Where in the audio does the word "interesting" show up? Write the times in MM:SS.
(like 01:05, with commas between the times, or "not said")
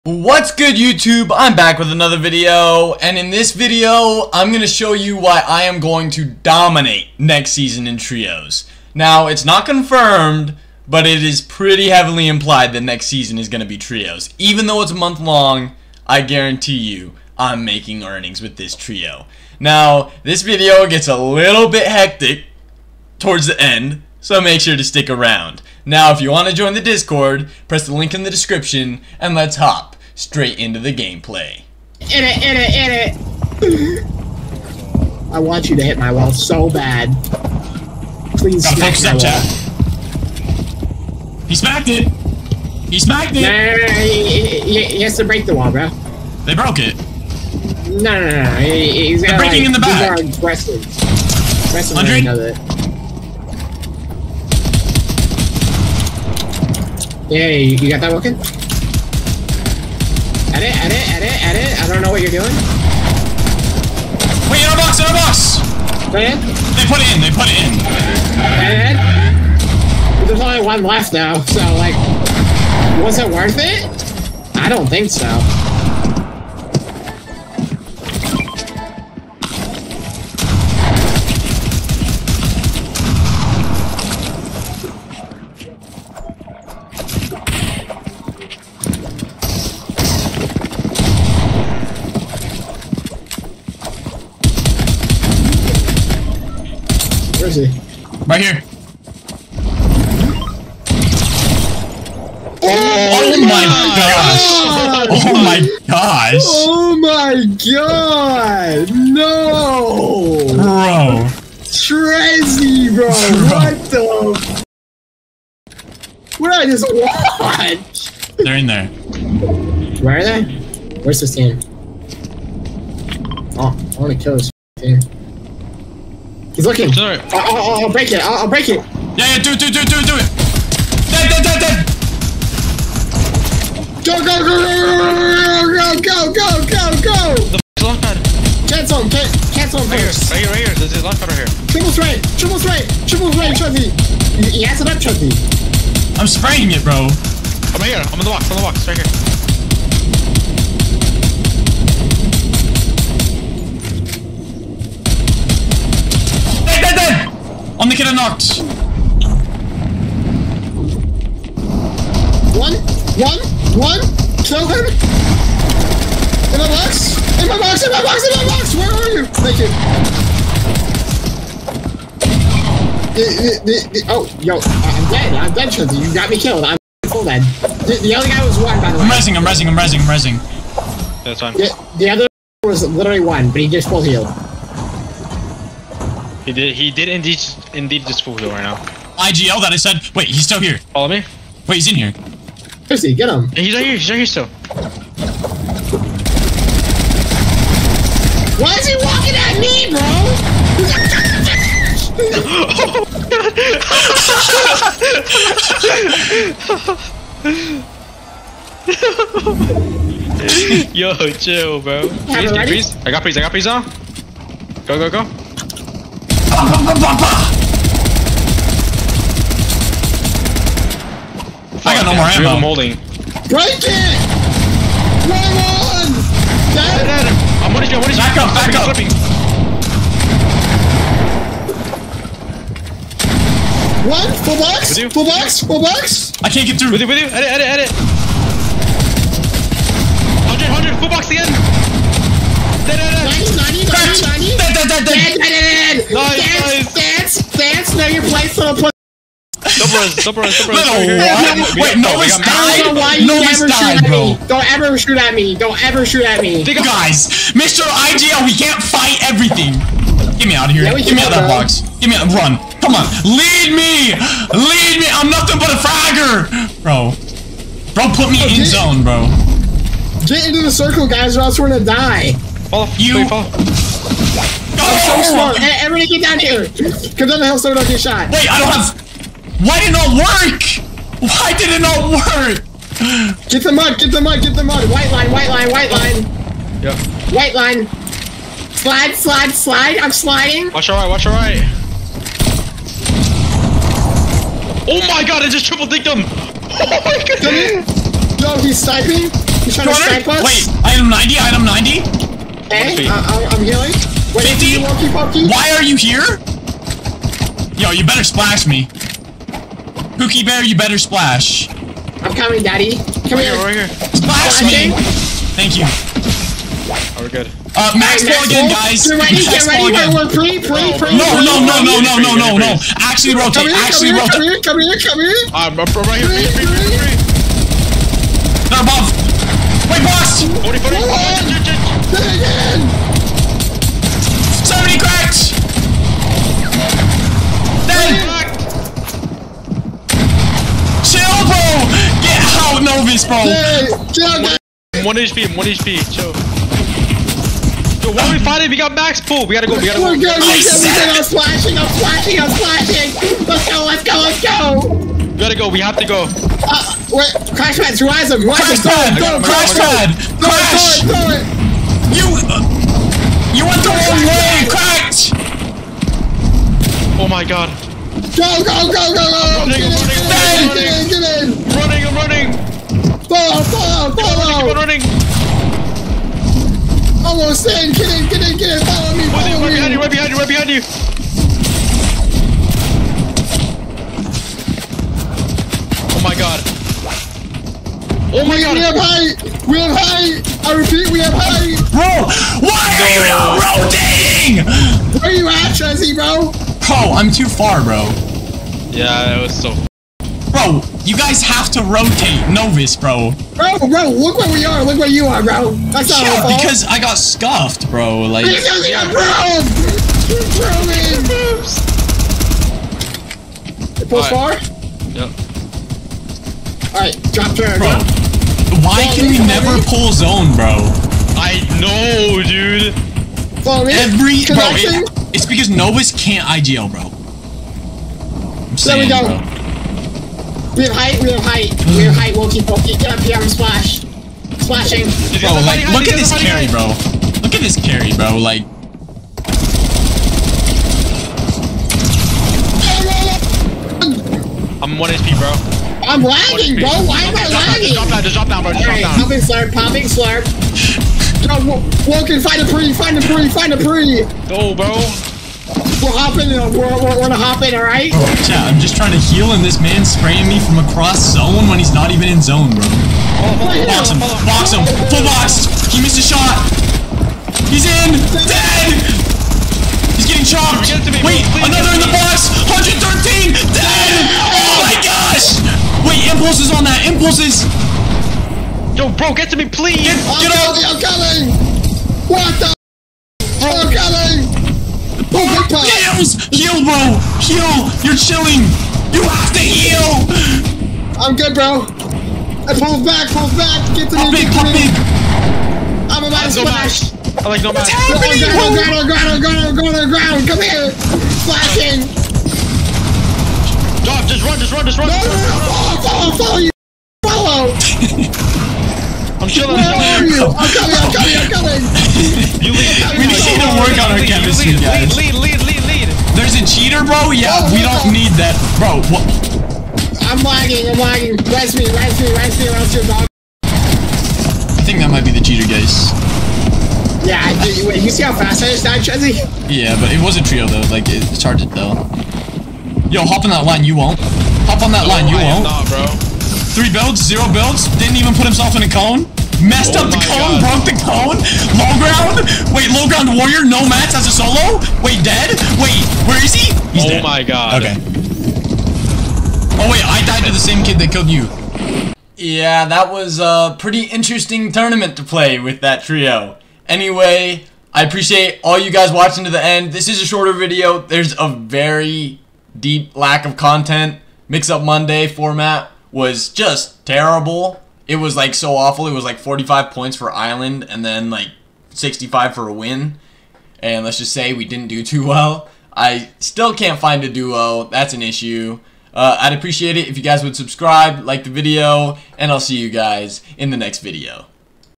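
09:14.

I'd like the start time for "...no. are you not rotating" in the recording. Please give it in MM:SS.
06:33.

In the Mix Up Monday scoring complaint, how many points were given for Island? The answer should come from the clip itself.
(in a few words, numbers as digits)
45.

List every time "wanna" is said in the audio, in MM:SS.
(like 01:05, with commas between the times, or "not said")
02:04.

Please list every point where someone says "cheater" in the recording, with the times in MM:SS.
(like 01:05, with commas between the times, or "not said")
08:36, 08:45.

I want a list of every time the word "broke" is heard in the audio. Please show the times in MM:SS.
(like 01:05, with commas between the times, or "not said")
00:46, 09:00.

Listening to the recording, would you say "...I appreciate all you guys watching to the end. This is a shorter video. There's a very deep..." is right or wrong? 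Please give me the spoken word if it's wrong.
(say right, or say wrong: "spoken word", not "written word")
right.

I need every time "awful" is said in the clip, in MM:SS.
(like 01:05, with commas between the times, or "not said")
09:28.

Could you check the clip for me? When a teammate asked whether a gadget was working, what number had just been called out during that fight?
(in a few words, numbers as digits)
100.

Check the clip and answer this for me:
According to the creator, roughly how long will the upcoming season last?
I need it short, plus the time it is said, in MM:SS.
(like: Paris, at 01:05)
a month, at 00:14.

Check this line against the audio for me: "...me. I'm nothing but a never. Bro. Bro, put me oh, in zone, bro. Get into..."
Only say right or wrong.
wrong.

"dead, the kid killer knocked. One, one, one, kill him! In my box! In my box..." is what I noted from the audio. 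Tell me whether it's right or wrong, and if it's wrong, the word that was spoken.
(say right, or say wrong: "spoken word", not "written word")
right.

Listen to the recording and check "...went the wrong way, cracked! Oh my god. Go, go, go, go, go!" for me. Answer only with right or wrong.
right.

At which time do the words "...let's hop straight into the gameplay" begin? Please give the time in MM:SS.
00:29.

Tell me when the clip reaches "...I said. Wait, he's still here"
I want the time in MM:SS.
03:09.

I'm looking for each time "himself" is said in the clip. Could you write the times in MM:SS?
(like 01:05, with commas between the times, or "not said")
08:58.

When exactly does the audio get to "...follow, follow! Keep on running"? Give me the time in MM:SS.
06:13.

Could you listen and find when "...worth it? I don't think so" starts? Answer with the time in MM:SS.
01:13.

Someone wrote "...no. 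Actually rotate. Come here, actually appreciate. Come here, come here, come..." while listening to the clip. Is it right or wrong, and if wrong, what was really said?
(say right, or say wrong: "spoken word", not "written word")
wrong: "rotate", not "appreciate".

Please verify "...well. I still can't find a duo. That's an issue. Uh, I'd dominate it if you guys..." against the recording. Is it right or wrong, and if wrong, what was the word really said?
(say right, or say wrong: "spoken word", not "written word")
wrong: "appreciate", not "dominate".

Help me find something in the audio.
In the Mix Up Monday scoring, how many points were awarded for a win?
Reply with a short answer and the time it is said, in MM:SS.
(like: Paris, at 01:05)
65, at 09:31.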